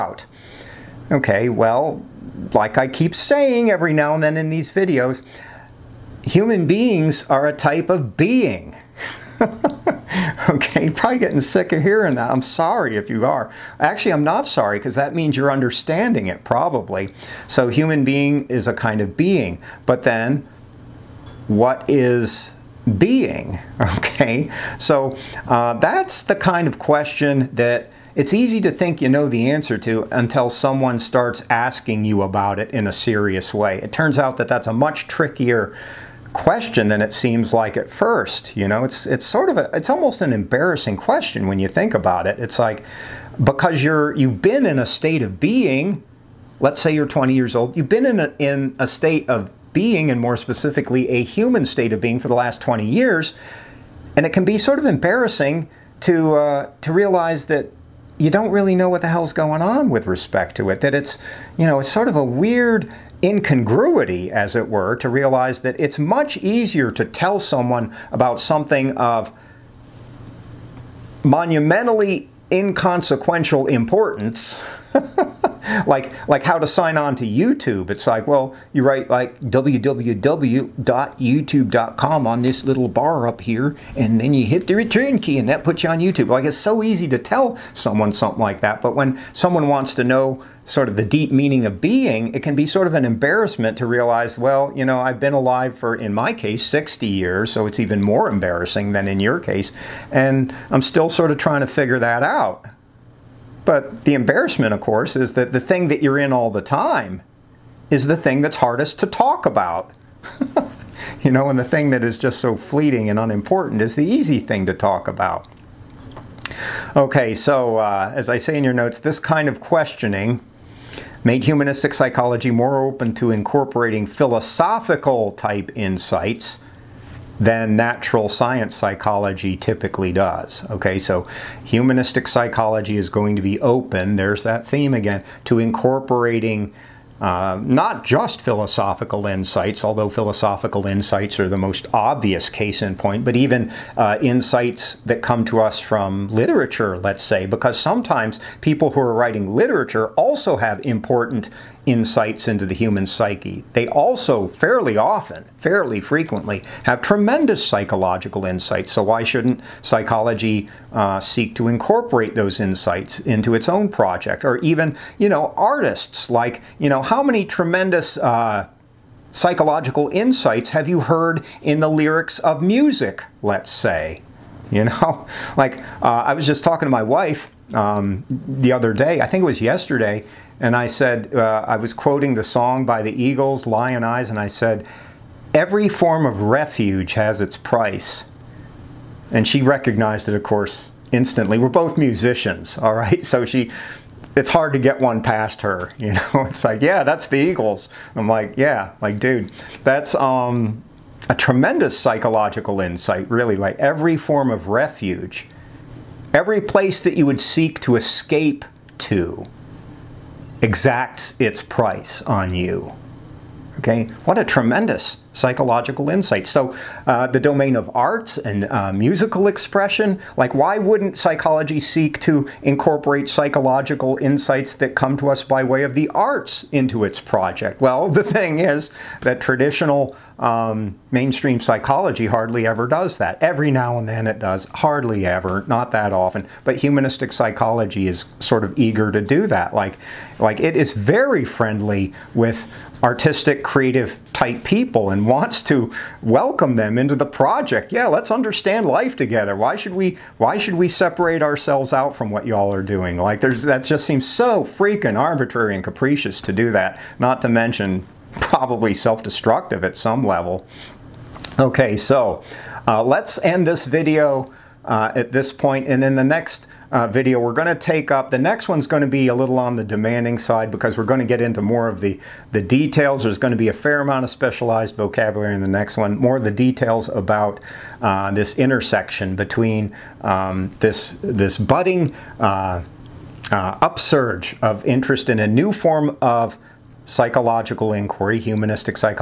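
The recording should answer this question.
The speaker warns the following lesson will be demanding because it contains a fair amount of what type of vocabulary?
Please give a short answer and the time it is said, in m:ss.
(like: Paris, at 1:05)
specialized, at 4:34.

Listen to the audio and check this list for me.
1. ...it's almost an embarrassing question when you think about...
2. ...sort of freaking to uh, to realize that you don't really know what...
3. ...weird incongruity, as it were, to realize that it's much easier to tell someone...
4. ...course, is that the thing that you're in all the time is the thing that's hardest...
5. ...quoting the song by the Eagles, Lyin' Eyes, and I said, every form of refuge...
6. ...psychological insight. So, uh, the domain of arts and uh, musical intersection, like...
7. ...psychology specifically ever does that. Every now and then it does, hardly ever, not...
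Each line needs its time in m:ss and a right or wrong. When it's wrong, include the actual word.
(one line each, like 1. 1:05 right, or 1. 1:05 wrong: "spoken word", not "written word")
1. 0:39 right
2. 0:54 wrong: "embarrassing", not "freaking"
3. 1:02 right
4. 1:44 right
5. 3:01 right
6. 3:35 wrong: "expression", not "intersection"
7. 3:51 wrong: "hardly", not "specifically".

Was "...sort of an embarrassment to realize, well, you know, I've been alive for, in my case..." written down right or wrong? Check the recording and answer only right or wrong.
right.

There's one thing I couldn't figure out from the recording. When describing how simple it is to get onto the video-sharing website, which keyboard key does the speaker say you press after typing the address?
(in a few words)
return key.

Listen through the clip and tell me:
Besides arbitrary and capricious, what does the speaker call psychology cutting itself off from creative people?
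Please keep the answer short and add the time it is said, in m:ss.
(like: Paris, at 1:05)
self-destructive, at 4:18.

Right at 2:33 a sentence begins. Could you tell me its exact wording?
They also fairly often, fairly frequently, have tremendous psychological insights.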